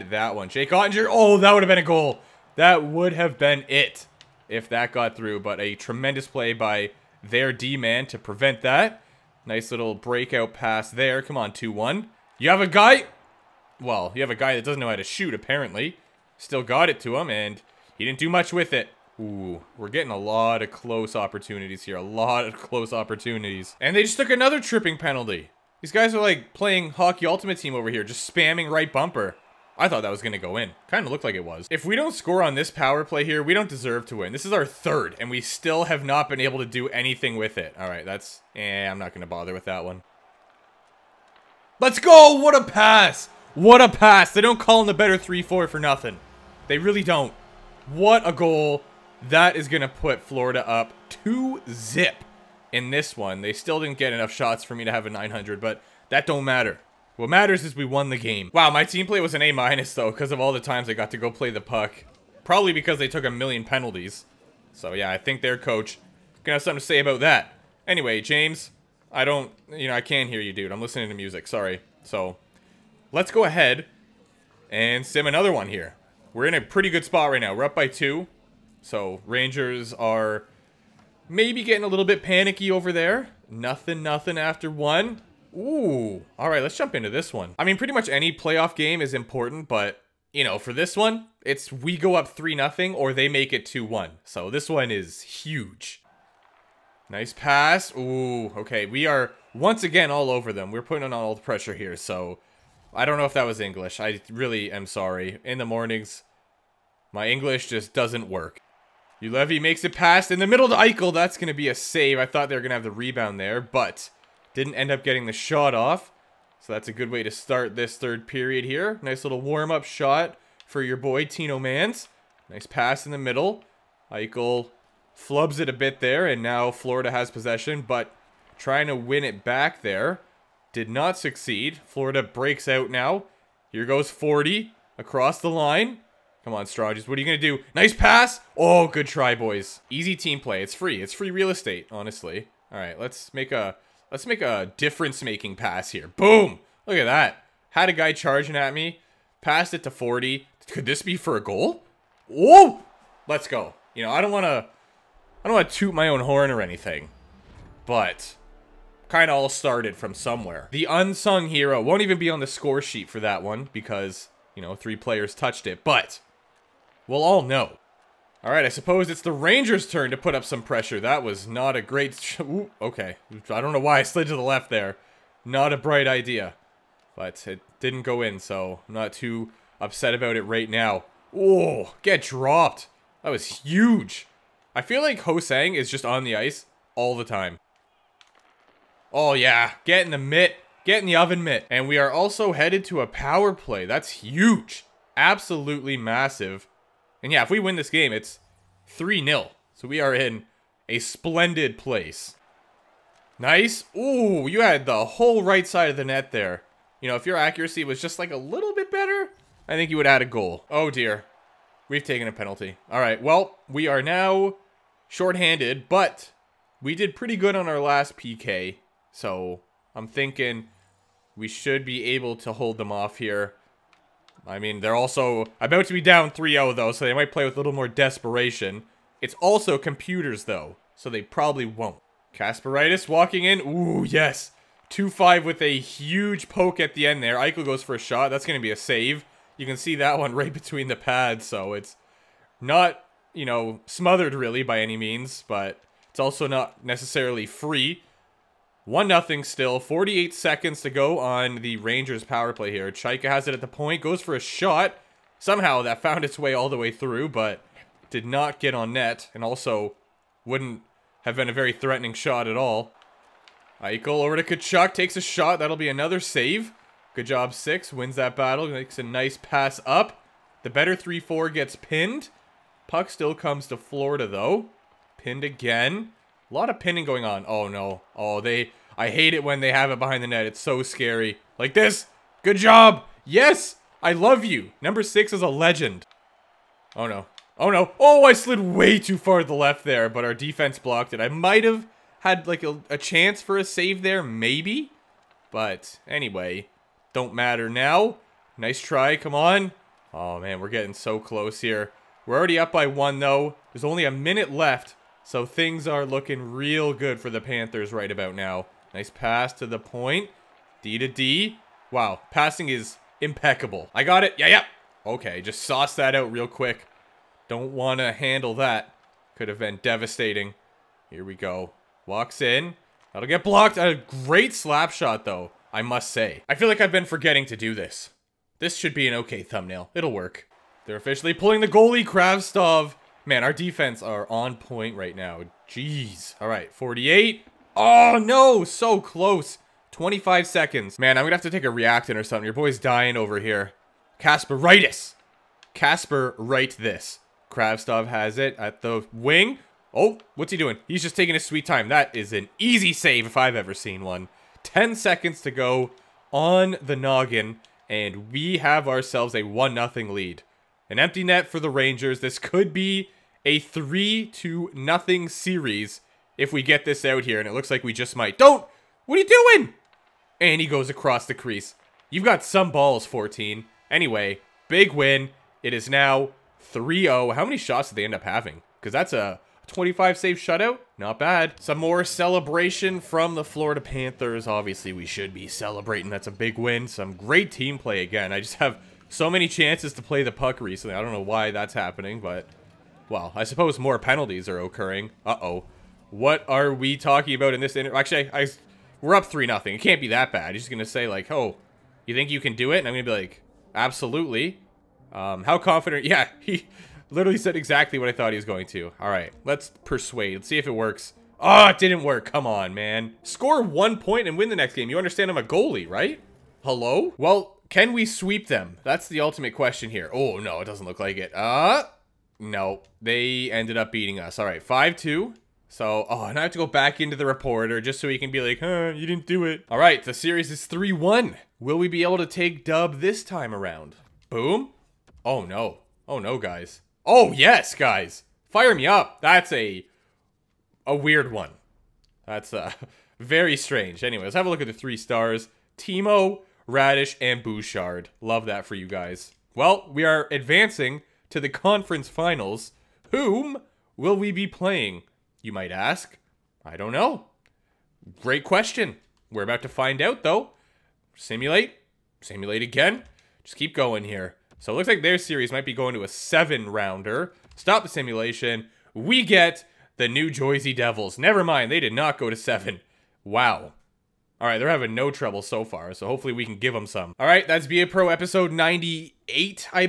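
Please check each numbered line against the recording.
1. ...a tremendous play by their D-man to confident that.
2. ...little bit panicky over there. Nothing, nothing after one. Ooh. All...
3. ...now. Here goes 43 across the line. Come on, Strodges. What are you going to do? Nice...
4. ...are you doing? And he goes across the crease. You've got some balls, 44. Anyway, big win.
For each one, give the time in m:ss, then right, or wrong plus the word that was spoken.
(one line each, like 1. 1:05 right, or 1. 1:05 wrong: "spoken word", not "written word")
1. 0:05 wrong: "prevent", not "confident"
2. 1:21 right
3. 2:12 wrong: "40", not "43"
4. 6:09 wrong: "14", not "44".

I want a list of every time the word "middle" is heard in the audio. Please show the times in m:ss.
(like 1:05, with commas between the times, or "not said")
1:50, 2:03.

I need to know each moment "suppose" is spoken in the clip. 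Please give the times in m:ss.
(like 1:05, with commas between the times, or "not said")
2:48, 6:33.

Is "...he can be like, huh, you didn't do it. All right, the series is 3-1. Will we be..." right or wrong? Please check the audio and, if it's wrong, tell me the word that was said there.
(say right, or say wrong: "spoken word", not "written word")
right.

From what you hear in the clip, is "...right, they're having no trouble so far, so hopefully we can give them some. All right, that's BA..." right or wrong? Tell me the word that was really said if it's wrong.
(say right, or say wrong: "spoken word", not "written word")
right.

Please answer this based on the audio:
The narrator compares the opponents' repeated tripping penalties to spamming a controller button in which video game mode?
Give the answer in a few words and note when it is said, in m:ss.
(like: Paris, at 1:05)
Hockey Ultimate Team, at 0:26.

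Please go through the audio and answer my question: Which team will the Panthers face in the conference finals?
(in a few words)
New Jersey Devils.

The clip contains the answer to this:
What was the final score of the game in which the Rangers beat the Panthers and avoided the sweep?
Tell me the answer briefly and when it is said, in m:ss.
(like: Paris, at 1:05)
5-2, at 7:04.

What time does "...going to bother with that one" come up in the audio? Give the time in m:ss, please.
0:39.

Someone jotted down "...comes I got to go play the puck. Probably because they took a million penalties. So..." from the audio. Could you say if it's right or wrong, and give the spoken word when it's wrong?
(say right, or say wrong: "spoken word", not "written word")
wrong: "times", not "comes".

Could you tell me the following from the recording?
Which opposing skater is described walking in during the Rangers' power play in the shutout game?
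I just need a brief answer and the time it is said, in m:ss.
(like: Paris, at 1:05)
Kasparaitis, at 3:52.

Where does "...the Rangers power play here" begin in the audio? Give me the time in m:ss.
4:11.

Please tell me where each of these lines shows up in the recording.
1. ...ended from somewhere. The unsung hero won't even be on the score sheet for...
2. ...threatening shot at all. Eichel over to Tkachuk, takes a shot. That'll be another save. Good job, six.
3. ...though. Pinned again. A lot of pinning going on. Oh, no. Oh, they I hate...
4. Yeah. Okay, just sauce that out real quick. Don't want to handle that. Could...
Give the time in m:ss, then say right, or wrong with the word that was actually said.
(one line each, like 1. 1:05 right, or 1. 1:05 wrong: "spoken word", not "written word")
1. 2:39 wrong: "started", not "ended"
2. 4:21 right
3. 4:34 right
4. 5:15 right.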